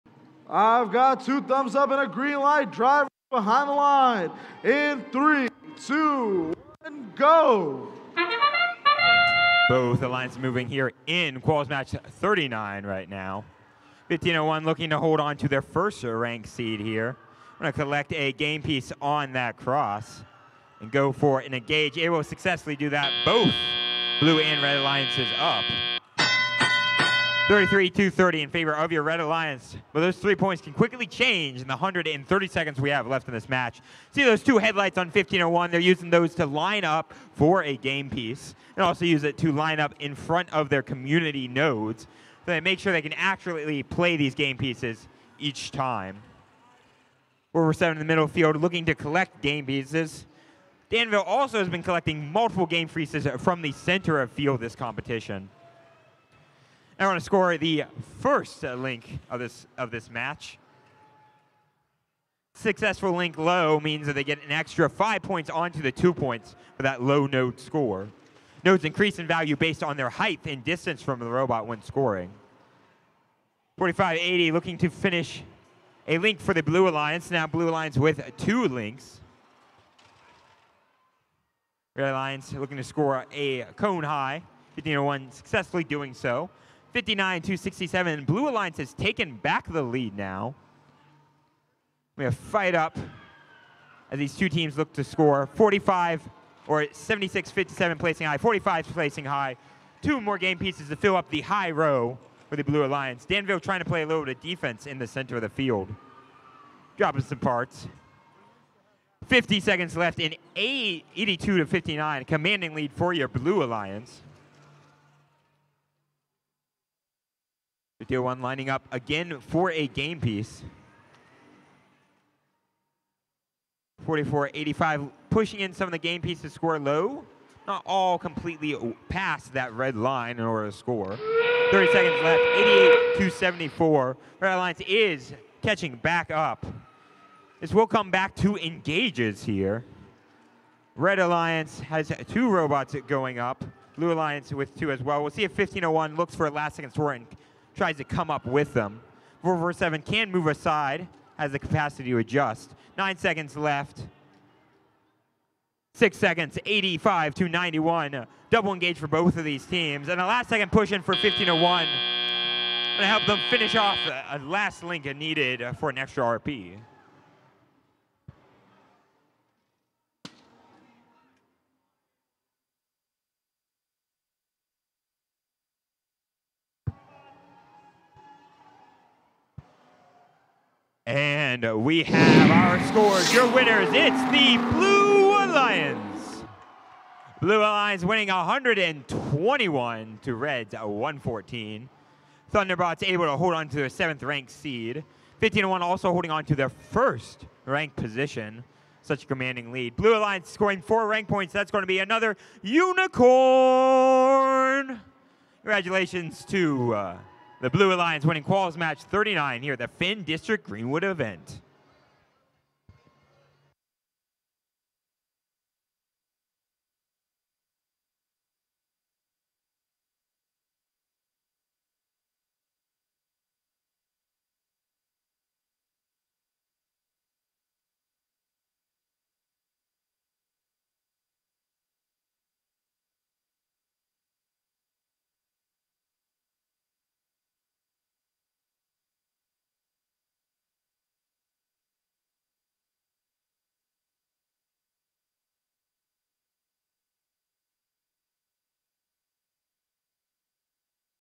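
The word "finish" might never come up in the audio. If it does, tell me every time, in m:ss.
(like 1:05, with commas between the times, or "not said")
1:14, 2:43.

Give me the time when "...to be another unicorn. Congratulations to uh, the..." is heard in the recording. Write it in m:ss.
3:21.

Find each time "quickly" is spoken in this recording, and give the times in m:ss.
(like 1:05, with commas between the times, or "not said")
0:30.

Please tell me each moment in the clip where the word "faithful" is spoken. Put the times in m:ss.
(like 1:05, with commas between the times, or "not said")
not said.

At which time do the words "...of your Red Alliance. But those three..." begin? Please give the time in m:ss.
0:28.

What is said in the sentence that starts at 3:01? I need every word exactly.
And we have our scores, your winners.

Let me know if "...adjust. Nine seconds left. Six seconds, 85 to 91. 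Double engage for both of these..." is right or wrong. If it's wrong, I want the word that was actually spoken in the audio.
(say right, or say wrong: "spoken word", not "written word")
right.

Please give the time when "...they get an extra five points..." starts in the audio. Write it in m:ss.
1:04.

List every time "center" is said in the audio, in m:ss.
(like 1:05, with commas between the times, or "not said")
0:53, 1:45.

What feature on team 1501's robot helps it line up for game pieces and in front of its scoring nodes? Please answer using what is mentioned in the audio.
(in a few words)
headlights.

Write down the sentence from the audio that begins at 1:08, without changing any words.
Nodes increase in value based on their height and distance from the robot when scoring.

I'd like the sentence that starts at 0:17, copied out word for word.
Going to collect a game piece on that cross and go for an engage.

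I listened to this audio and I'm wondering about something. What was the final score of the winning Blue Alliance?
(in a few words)
121.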